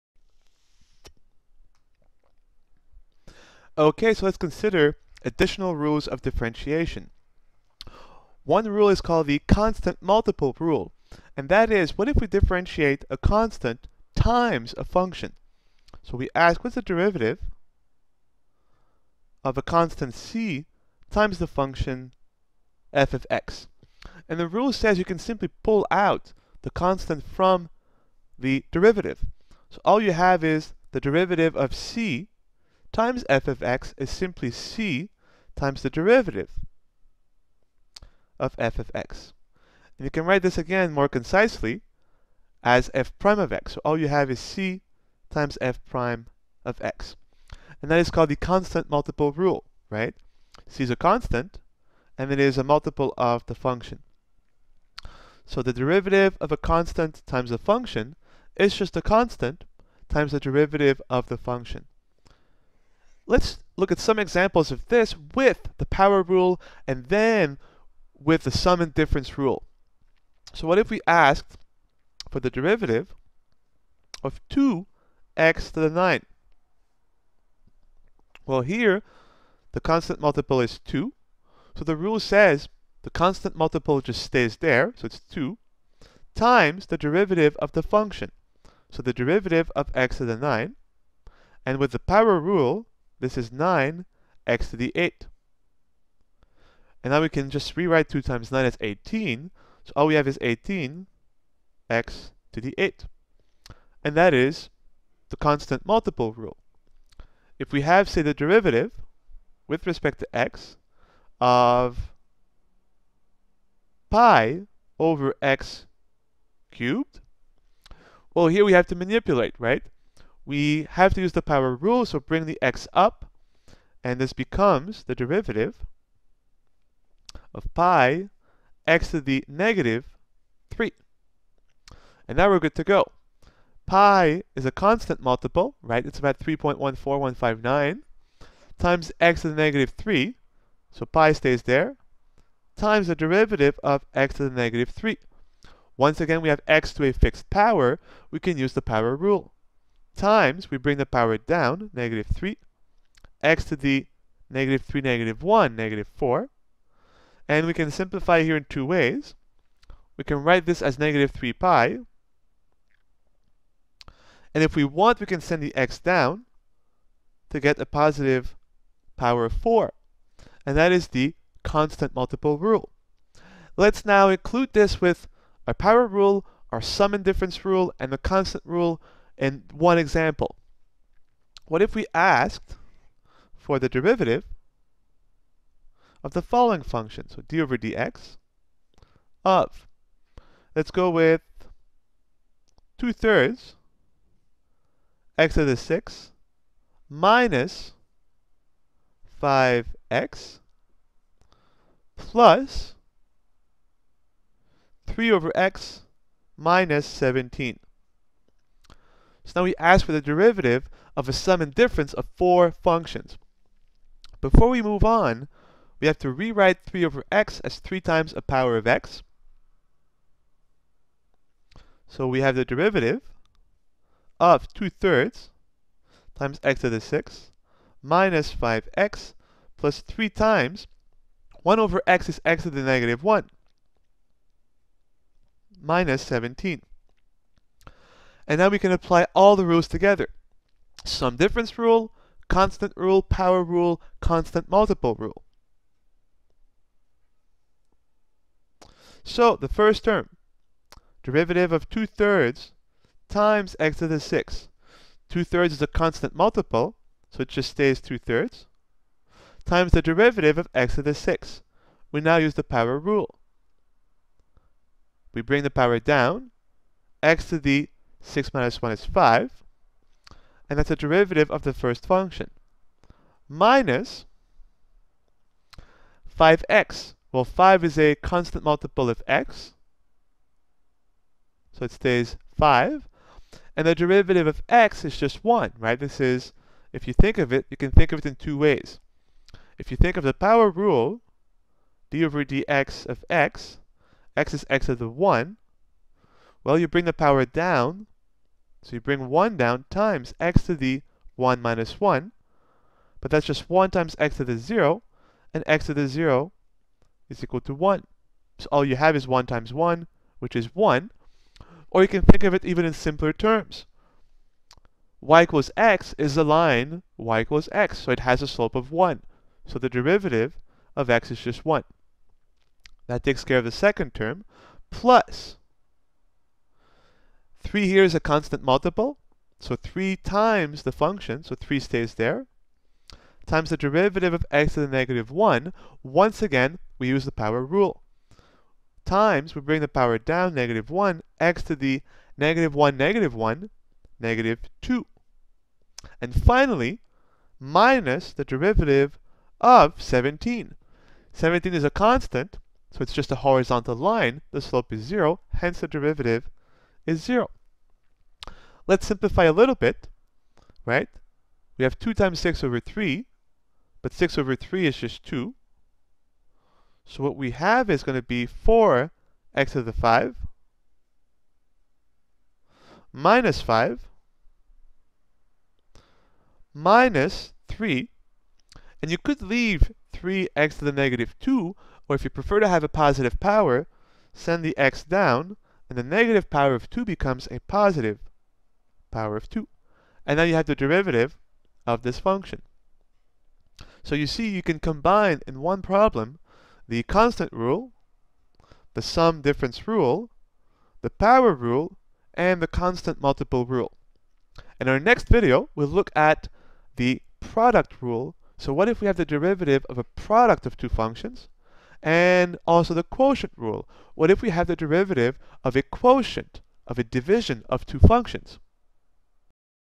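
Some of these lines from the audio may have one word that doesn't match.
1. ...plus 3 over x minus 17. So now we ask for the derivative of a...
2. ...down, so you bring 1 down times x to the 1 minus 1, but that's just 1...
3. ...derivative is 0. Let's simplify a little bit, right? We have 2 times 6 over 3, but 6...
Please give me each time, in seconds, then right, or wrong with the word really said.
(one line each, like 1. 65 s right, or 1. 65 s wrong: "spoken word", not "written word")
1. 202 s right
2. 297 s right
3. 355 s right.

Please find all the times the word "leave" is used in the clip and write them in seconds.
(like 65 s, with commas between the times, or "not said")
379 s.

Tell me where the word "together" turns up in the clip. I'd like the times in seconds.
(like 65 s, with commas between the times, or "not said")
239 s.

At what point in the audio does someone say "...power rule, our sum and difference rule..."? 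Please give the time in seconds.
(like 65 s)
175 s.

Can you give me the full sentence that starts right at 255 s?
2 thirds is a constant multiple, so it just stays 2 thirds, times the derivative of x to the 6.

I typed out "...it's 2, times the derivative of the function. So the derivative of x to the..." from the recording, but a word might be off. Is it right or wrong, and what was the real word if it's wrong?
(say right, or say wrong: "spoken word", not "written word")
right.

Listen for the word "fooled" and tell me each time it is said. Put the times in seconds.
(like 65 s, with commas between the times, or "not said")
not said.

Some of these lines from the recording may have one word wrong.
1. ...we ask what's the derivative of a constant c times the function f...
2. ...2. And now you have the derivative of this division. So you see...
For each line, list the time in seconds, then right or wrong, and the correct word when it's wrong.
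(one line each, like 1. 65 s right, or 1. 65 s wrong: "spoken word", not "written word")
1. 16 s right
2. 389 s wrong: "function", not "division".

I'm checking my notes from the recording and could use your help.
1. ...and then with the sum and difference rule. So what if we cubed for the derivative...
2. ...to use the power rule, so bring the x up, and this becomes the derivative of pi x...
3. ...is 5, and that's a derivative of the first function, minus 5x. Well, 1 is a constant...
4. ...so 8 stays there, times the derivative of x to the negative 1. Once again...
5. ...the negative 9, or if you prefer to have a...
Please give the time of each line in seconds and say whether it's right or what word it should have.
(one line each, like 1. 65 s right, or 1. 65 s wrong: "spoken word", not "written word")
1. 66 s wrong: "asked", not "cubed"
2. 121 s right
3. 268 s wrong: "5", not "1"
4. 331 s wrong: "3", not "8"
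5. 380 s wrong: "2", not "9".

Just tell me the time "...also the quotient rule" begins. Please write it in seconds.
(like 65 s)
412 s.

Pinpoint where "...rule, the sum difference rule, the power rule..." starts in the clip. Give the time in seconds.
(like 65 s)
397 s.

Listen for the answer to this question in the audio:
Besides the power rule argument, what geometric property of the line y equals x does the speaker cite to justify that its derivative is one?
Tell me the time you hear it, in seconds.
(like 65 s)
318 s.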